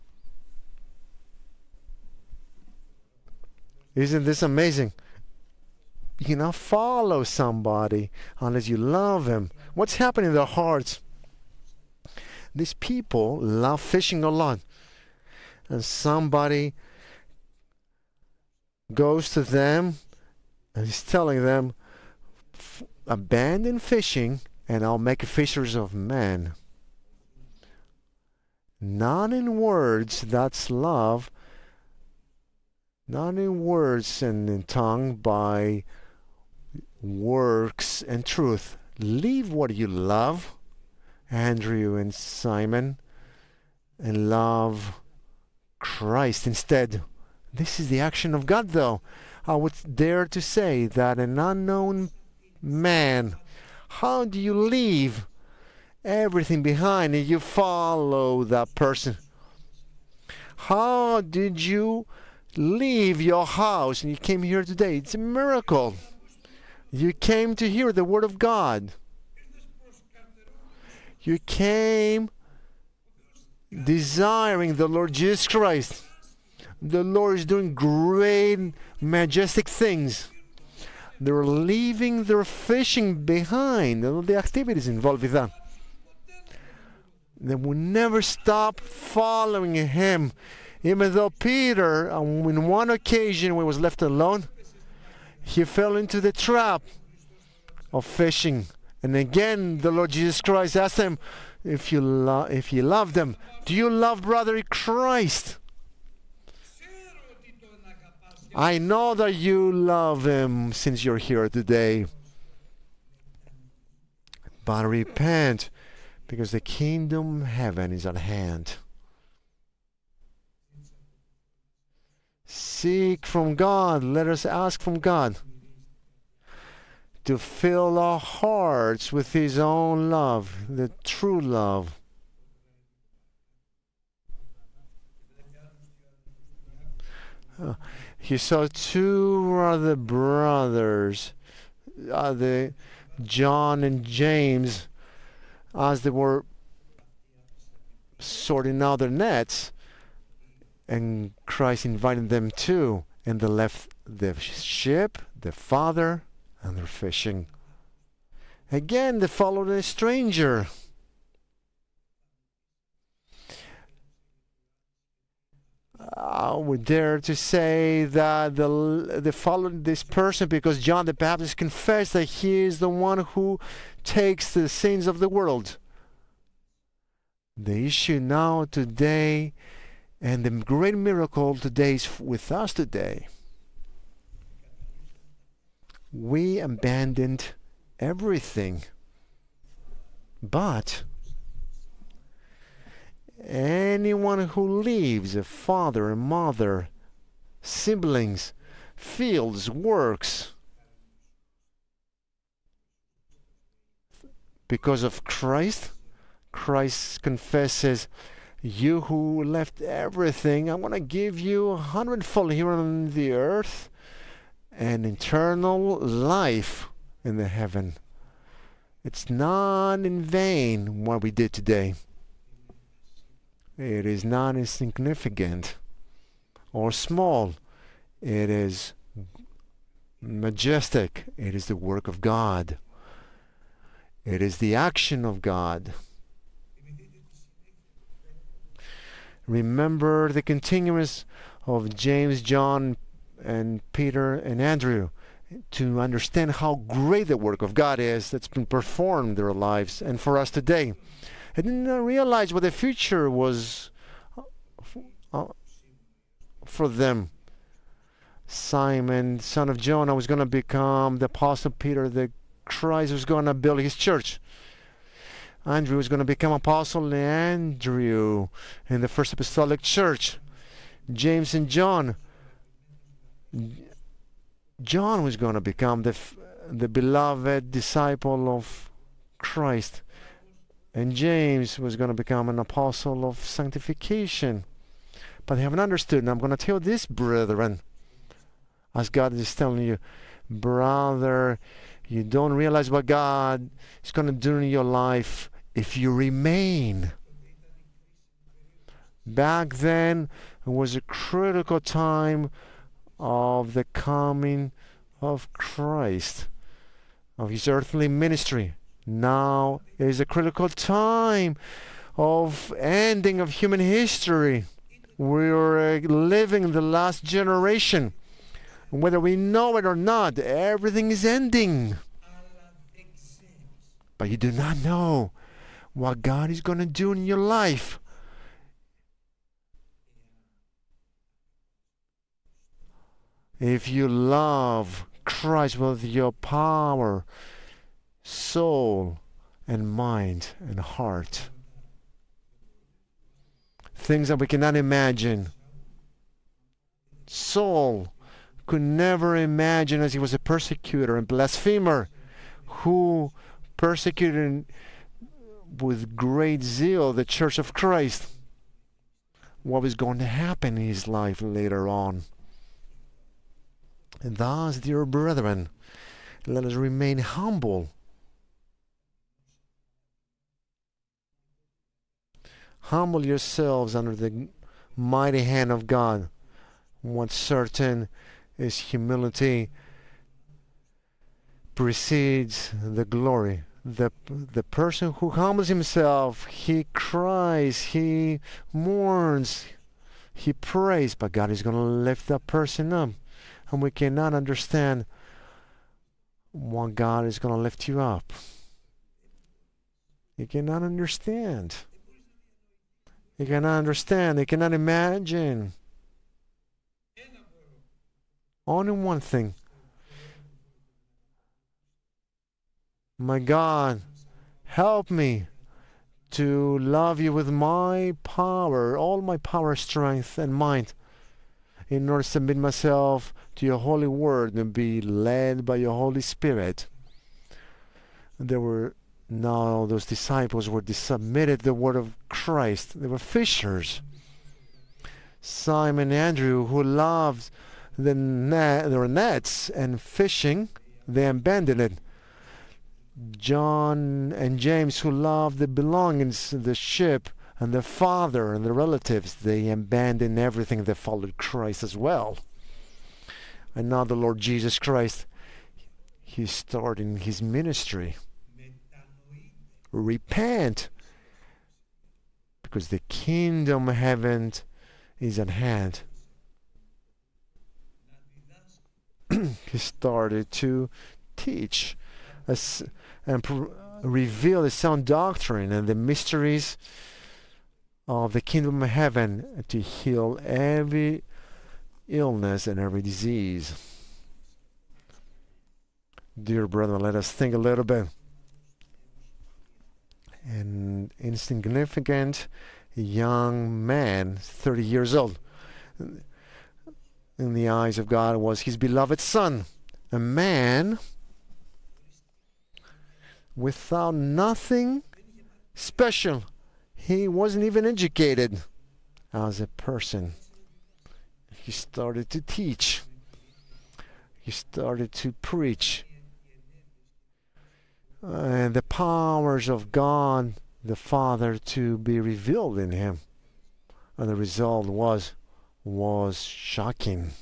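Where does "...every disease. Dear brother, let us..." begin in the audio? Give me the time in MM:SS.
08:02.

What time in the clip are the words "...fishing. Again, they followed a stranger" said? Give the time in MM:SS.
02:36.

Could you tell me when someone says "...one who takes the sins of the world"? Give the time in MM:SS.
02:52.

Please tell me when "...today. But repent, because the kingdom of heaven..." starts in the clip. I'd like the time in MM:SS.
01:51.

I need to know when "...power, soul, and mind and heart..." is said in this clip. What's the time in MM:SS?
05:36.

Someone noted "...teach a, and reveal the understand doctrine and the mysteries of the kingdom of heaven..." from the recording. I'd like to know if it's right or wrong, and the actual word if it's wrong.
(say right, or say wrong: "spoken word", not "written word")
wrong: "sound", not "understand".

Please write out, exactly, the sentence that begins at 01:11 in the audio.
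You came desiring the Lord Jesus Christ.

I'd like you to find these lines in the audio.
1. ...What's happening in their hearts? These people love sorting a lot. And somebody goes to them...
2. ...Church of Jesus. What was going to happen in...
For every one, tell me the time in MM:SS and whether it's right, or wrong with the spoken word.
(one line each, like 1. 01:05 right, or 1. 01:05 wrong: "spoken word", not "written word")
1. 00:09 wrong: "fishing", not "sorting"
2. 05:57 wrong: "Christ", not "Jesus".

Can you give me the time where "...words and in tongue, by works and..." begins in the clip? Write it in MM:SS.
00:33.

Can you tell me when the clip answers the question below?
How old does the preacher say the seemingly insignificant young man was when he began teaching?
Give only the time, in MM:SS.
08:14.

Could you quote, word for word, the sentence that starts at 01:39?
And again, the Lord Jesus Christ asked him, if you, lo- if you love them, do you love brother Christ?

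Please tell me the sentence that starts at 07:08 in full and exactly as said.
There were now those disciples were submitted the word of Christ.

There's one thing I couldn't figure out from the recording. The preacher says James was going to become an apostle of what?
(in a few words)
sanctification.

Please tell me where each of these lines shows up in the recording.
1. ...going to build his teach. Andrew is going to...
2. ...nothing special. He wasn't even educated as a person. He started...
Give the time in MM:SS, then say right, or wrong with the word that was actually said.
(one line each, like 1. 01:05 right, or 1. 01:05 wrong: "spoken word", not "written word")
1. 04:23 wrong: "church", not "teach"
2. 08:24 right.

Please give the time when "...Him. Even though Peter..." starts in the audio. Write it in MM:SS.
01:29.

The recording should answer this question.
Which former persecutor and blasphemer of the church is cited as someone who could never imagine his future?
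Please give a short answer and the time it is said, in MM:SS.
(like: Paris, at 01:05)
Saul, at 05:47.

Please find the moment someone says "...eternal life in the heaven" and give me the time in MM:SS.
03:35.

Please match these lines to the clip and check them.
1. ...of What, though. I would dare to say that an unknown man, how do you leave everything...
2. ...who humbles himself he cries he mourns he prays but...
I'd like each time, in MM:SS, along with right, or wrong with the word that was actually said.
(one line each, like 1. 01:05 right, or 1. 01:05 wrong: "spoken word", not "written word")
1. 00:48 wrong: "God", not "What"
2. 06:25 right.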